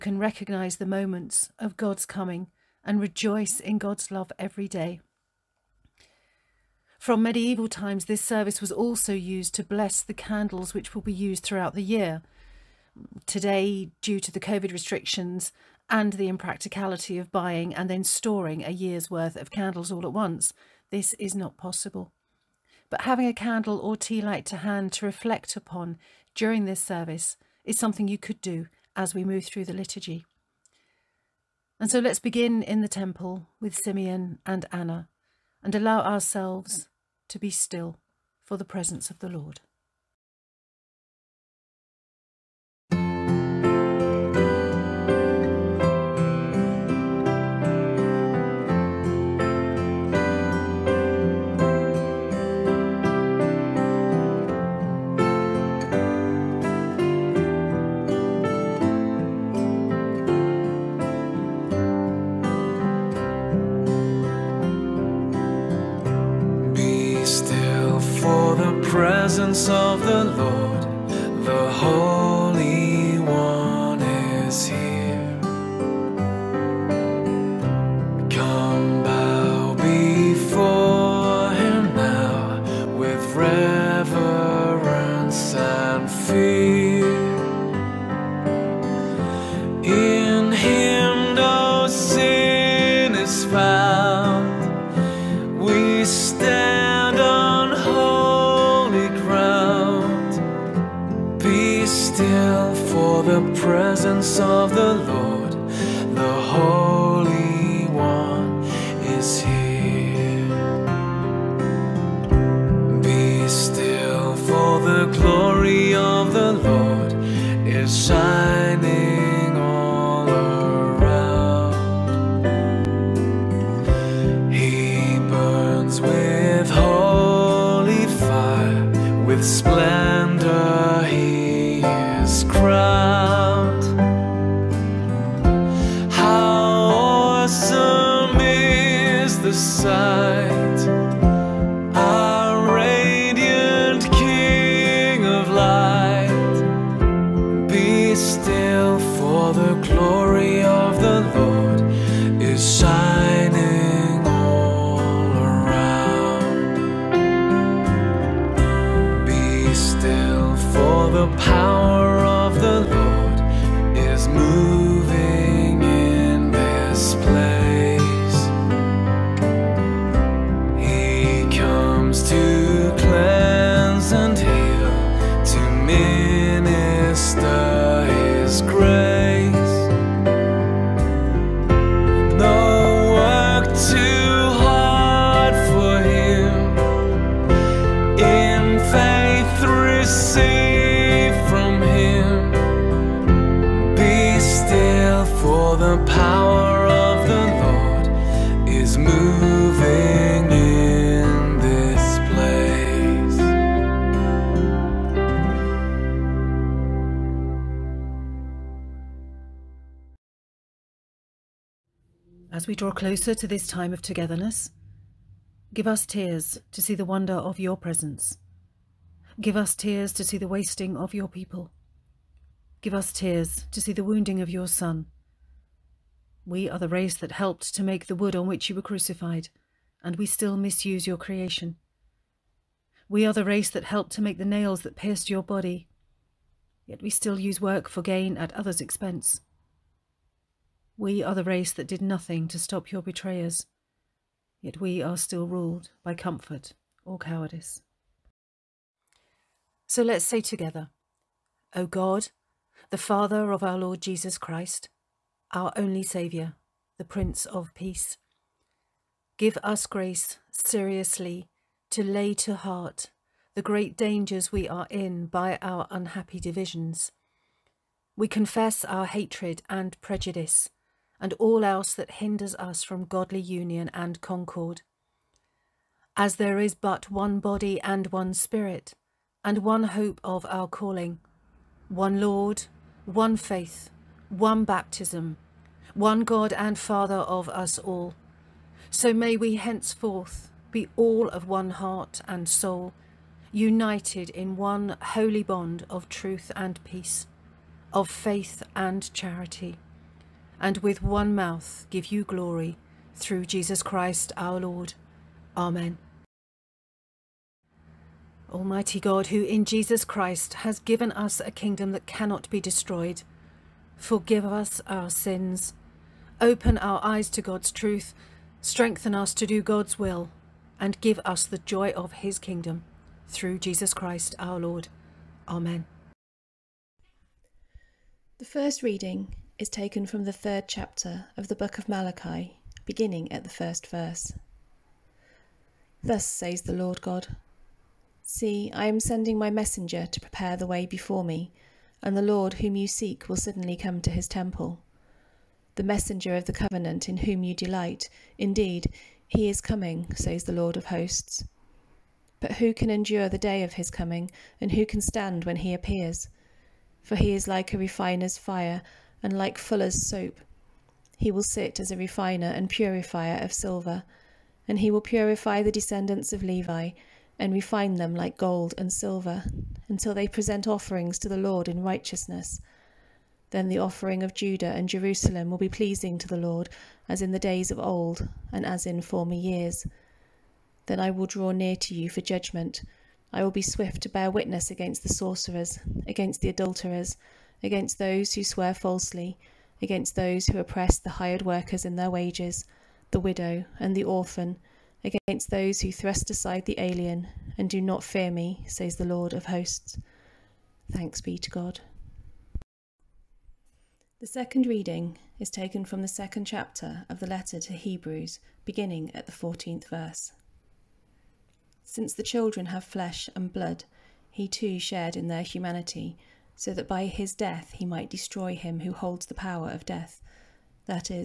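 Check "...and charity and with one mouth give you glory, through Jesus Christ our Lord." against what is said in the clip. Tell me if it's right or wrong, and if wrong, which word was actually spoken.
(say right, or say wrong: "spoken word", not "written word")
right.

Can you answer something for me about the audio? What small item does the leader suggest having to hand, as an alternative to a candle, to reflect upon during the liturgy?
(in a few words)
Tea light.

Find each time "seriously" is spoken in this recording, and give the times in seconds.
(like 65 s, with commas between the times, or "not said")
260 s.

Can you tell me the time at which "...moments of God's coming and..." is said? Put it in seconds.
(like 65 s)
0 s.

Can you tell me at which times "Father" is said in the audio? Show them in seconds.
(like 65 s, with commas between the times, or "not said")
252 s, 286 s.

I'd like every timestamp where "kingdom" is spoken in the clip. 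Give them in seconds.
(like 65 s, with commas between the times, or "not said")
311 s, 322 s.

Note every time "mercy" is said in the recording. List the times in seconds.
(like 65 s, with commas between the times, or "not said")
not said.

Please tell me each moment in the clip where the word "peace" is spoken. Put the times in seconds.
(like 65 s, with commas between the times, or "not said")
257 s, 296 s.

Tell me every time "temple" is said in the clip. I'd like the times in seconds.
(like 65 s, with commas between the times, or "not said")
32 s, 344 s.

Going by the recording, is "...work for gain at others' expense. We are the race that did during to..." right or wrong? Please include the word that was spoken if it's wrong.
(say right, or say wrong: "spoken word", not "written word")
wrong: "nothing", not "during".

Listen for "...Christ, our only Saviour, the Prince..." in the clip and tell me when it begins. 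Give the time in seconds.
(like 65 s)
254 s.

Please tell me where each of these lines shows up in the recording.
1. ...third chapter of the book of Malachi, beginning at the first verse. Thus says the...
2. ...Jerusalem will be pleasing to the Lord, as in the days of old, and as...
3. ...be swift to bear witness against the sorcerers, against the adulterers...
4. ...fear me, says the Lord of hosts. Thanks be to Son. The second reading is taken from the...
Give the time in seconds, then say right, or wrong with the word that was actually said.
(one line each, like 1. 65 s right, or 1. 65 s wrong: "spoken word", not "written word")
1. 330 s right
2. 374 s right
3. 383 s right
4. 398 s wrong: "God", not "Son".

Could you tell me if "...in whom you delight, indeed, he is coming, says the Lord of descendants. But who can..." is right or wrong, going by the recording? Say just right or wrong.
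wrong.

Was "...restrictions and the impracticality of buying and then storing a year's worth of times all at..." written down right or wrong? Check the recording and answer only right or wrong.
wrong.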